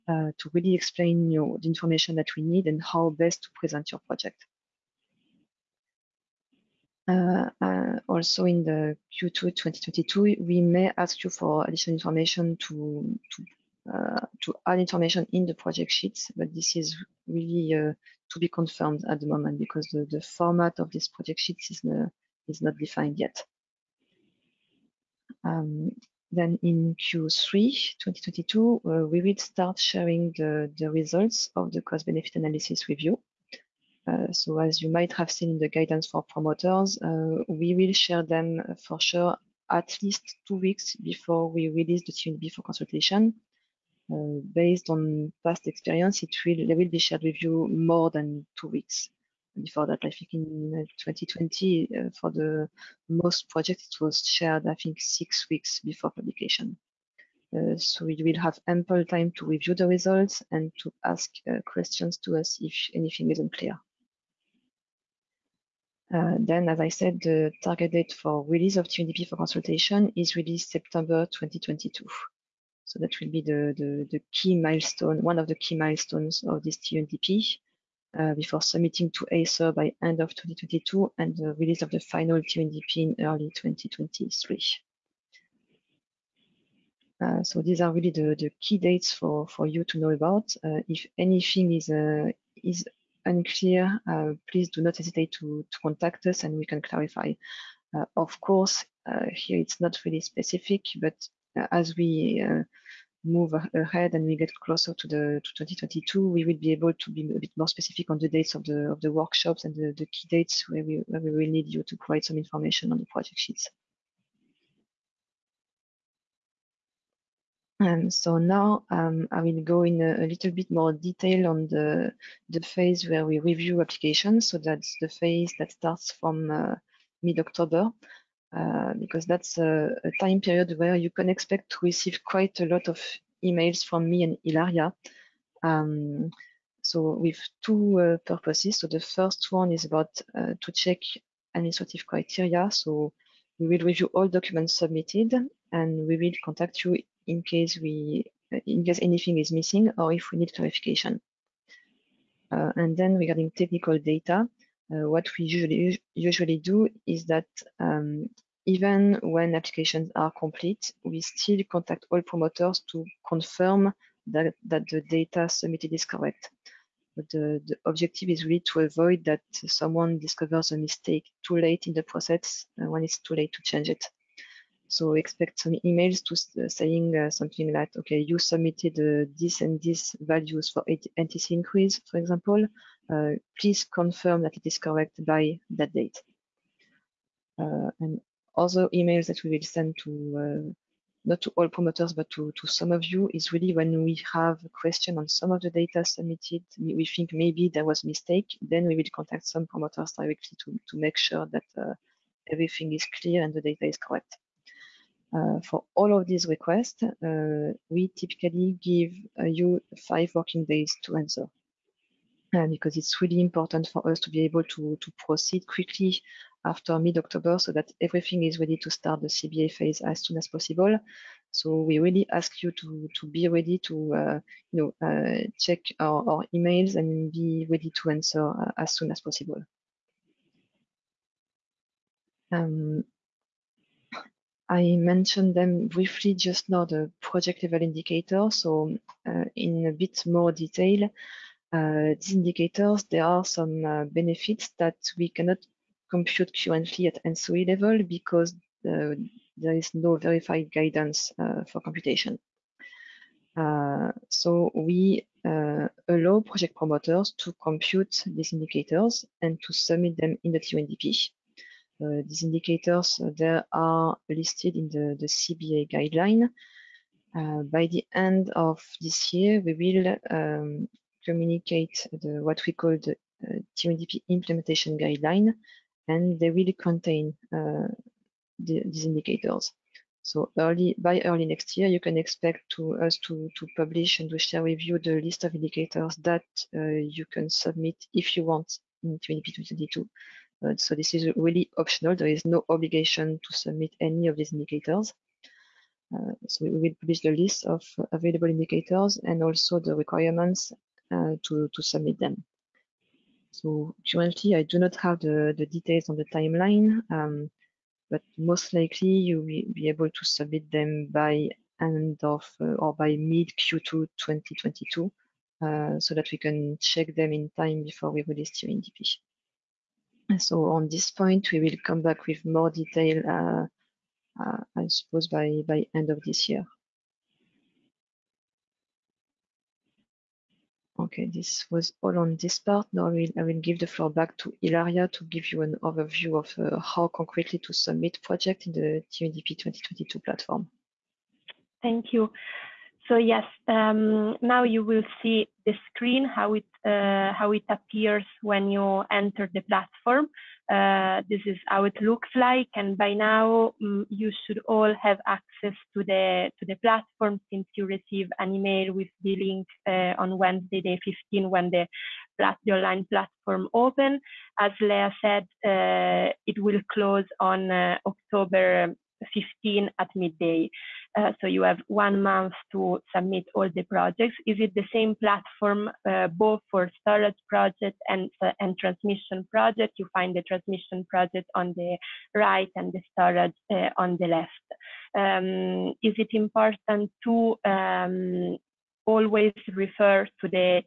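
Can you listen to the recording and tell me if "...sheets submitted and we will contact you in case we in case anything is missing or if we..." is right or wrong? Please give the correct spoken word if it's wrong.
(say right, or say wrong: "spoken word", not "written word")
wrong: "documents", not "sheets".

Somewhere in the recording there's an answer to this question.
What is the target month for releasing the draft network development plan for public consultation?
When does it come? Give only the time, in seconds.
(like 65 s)
70 s.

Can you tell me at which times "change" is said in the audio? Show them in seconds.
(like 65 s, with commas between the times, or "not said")
173 s.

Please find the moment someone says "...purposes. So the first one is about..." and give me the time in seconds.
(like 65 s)
138 s.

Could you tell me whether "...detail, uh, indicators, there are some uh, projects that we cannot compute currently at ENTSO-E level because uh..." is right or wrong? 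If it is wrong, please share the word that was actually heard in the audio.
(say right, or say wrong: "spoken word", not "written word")
wrong: "benefits", not "projects".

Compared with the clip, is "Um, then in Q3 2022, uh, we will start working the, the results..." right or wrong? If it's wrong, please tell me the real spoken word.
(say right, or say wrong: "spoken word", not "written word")
wrong: "sharing", not "working".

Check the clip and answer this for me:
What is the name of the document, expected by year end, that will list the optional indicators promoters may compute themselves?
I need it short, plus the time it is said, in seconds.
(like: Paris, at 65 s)
TYNDP implementation guideline, at 273 s.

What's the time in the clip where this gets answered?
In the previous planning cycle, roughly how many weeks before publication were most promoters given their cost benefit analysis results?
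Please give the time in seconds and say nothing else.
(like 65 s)
54 s.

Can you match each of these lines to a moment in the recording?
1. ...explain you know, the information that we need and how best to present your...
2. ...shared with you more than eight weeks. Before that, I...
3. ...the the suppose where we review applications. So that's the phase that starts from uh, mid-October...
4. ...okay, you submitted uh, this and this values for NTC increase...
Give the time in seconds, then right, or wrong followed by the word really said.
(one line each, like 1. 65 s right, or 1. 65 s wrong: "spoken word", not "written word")
1. 0 s right
2. 46 s wrong: "two", not "eight"
3. 121 s wrong: "phase", not "suppose"
4. 177 s right.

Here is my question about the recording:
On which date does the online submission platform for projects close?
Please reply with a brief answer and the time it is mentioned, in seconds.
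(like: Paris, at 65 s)
October 15, at 368 s.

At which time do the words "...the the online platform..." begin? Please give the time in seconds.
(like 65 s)
361 s.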